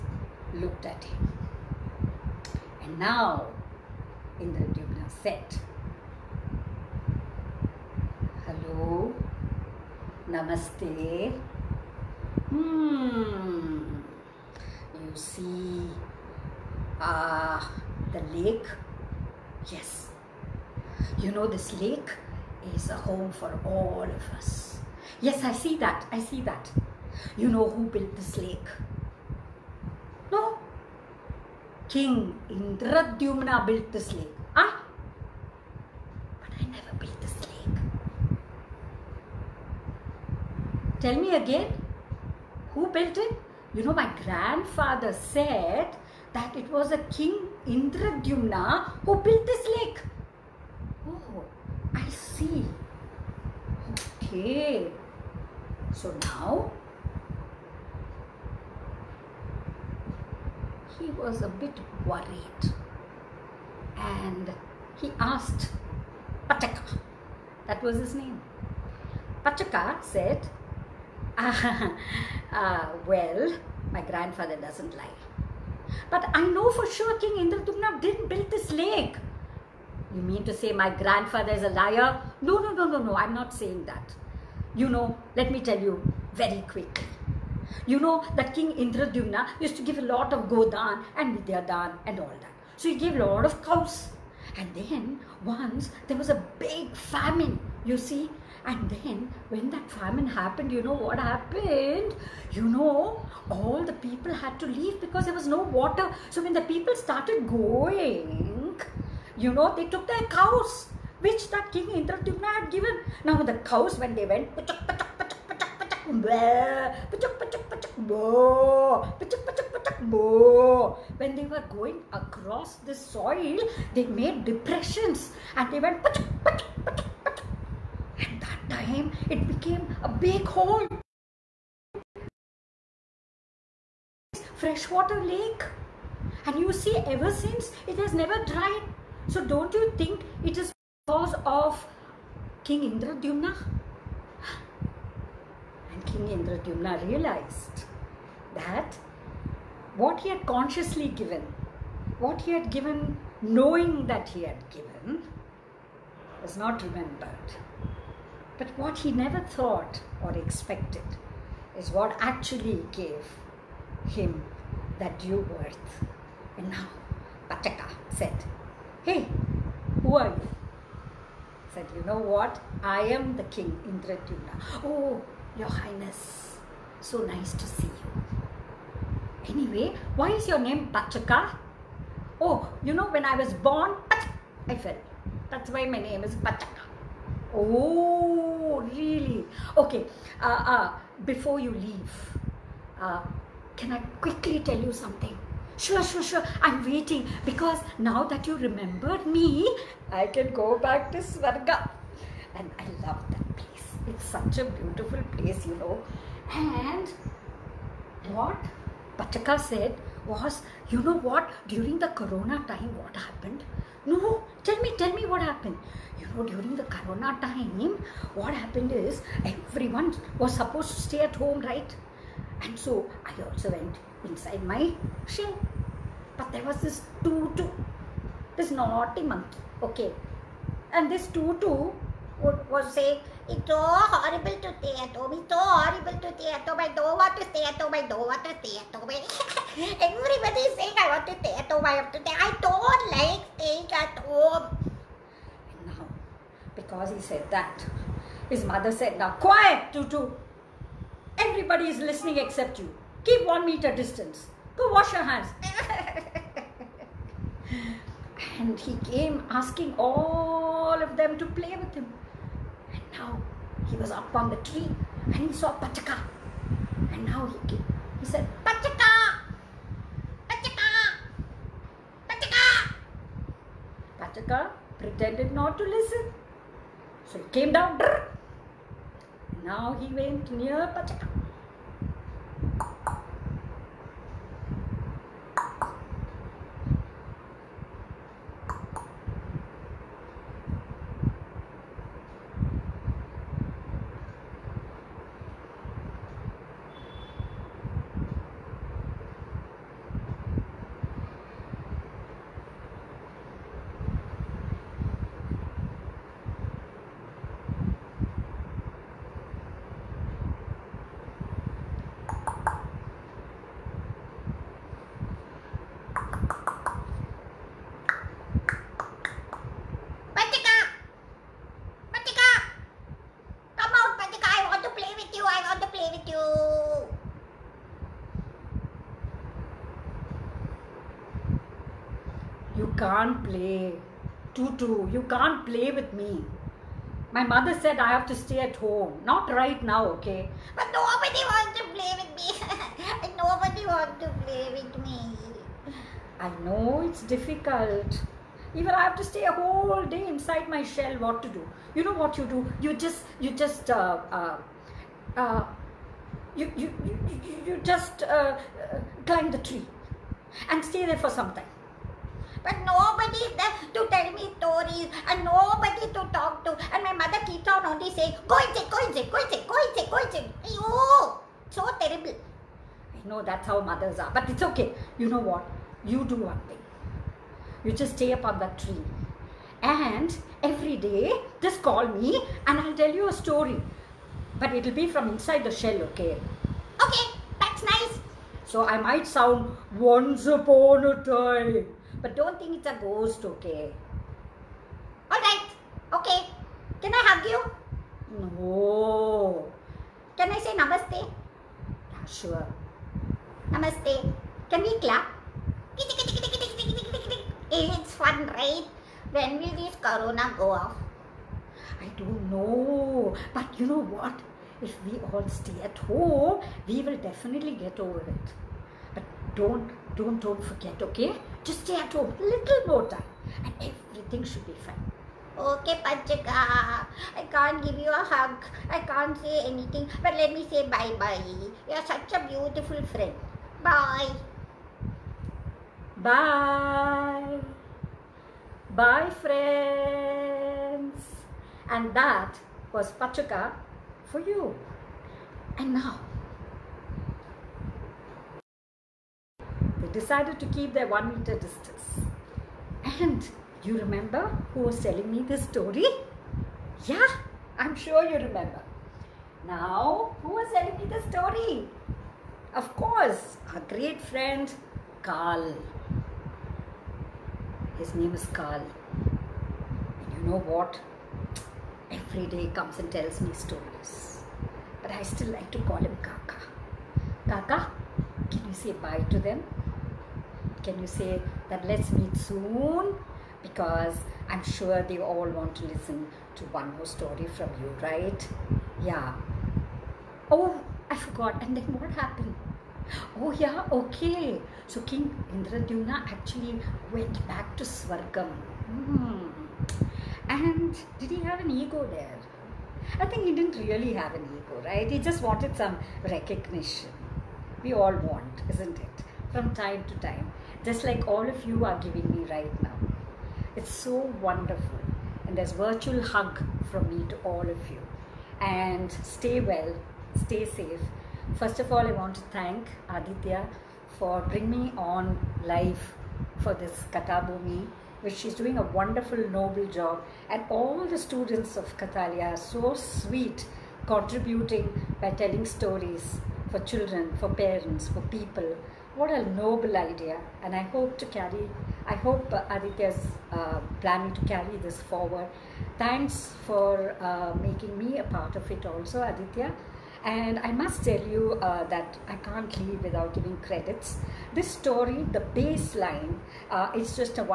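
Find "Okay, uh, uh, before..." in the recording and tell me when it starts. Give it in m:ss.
3:09.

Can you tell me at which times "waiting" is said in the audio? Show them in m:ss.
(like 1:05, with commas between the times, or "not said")
3:16.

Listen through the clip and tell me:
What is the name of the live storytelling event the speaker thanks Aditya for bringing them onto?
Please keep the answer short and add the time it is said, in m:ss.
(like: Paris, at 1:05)
Kathabhoomi, at 8:47.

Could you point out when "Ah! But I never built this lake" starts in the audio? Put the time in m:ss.
0:34.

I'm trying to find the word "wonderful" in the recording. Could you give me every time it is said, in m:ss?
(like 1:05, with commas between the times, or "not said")
8:34, 8:48.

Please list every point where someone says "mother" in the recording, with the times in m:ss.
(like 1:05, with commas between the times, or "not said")
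4:08, 5:37, 6:07, 6:13.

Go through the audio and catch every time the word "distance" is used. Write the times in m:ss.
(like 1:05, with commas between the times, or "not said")
4:13, 7:31.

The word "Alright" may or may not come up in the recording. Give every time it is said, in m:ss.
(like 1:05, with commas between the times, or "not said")
6:35.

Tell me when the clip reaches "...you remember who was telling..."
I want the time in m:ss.
7:33.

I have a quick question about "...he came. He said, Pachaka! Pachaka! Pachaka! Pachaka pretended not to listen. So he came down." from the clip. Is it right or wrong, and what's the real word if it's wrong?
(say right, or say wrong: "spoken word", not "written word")
right.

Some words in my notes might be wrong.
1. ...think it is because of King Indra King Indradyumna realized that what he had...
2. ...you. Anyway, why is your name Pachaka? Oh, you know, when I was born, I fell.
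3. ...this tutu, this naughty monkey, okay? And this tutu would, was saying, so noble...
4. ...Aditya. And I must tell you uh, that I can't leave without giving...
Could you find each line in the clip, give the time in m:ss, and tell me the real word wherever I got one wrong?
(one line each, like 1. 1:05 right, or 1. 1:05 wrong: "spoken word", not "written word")
1. 2:19 right
2. 2:57 right
3. 3:46 wrong: "horrible", not "noble"
4. 9:09 right.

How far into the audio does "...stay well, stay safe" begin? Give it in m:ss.
8:39.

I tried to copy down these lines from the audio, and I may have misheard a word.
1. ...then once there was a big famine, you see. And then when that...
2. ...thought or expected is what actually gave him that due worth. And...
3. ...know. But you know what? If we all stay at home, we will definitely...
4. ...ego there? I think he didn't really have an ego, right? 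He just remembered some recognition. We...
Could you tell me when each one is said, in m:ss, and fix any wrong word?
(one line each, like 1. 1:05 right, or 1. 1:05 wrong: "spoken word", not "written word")
1. 1:34 right
2. 2:39 right
3. 6:52 right
4. 8:21 wrong: "wanted", not "remembered".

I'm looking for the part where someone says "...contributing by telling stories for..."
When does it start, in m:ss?
8:54.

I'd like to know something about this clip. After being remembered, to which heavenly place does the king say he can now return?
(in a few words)
Svarga.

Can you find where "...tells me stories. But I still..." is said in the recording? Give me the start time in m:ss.
7:53.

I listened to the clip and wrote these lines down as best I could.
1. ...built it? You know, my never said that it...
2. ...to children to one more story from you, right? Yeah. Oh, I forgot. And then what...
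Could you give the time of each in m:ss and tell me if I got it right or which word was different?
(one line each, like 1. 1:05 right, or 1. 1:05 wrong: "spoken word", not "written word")
1. 0:42 wrong: "grandfather", not "never"
2. 8:05 wrong: "listen", not "children".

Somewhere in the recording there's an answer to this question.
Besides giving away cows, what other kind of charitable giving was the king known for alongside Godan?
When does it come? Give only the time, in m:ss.
1:31.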